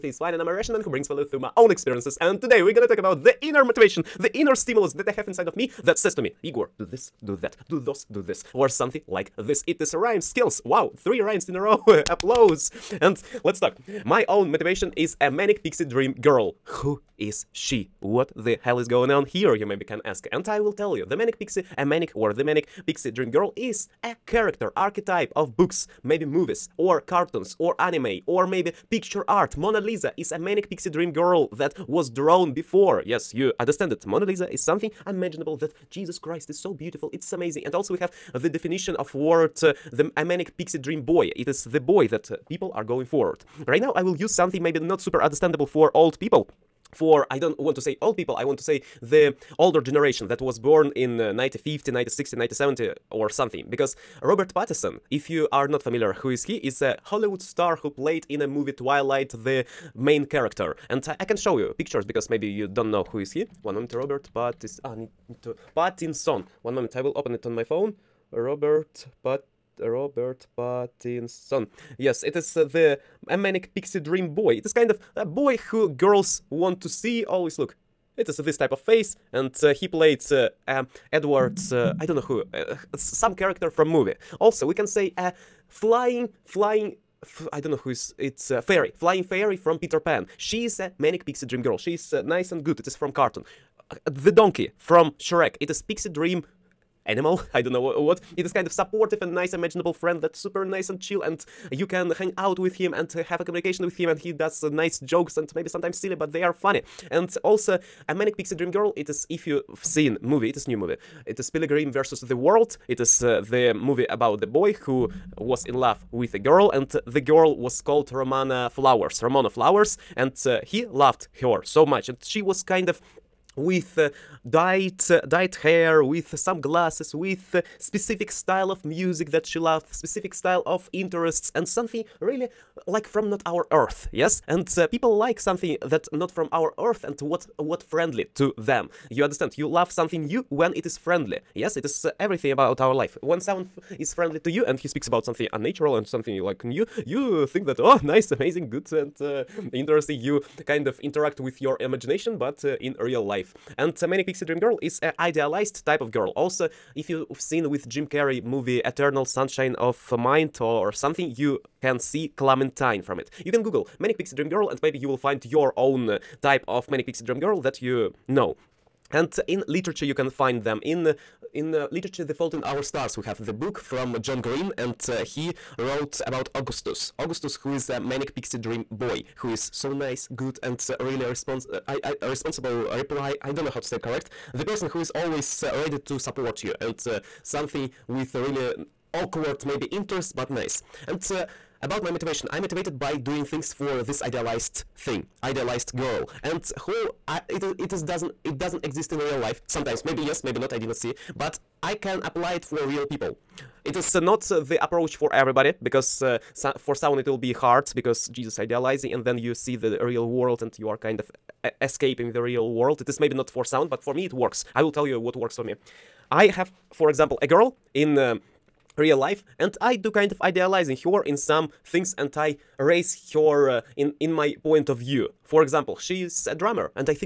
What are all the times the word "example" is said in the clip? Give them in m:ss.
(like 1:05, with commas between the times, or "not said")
3:37, 3:45.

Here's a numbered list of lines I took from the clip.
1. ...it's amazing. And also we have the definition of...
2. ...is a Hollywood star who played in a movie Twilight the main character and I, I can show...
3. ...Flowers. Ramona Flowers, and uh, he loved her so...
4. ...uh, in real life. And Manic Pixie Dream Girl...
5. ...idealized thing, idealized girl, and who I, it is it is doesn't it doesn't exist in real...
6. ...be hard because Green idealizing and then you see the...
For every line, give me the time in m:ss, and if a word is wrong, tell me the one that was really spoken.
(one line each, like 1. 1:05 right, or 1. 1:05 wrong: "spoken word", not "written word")
1. 0:37 right
2. 0:56 right
3. 1:58 right
4. 2:32 right
5. 3:14 right
6. 3:27 wrong: "Jesus", not "Green".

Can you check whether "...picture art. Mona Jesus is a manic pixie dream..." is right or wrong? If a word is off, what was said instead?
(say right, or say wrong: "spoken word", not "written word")
wrong: "Lisa", not "Jesus".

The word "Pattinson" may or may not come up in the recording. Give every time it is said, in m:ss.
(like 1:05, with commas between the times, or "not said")
0:54, 1:05, 1:10.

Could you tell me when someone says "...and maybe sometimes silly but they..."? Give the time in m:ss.
1:45.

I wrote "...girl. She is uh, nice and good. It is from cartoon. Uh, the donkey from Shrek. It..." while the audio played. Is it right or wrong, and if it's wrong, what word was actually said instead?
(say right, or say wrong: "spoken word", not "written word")
right.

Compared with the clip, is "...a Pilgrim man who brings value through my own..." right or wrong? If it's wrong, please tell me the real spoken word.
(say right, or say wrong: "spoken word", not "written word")
wrong: "Russian", not "Pilgrim".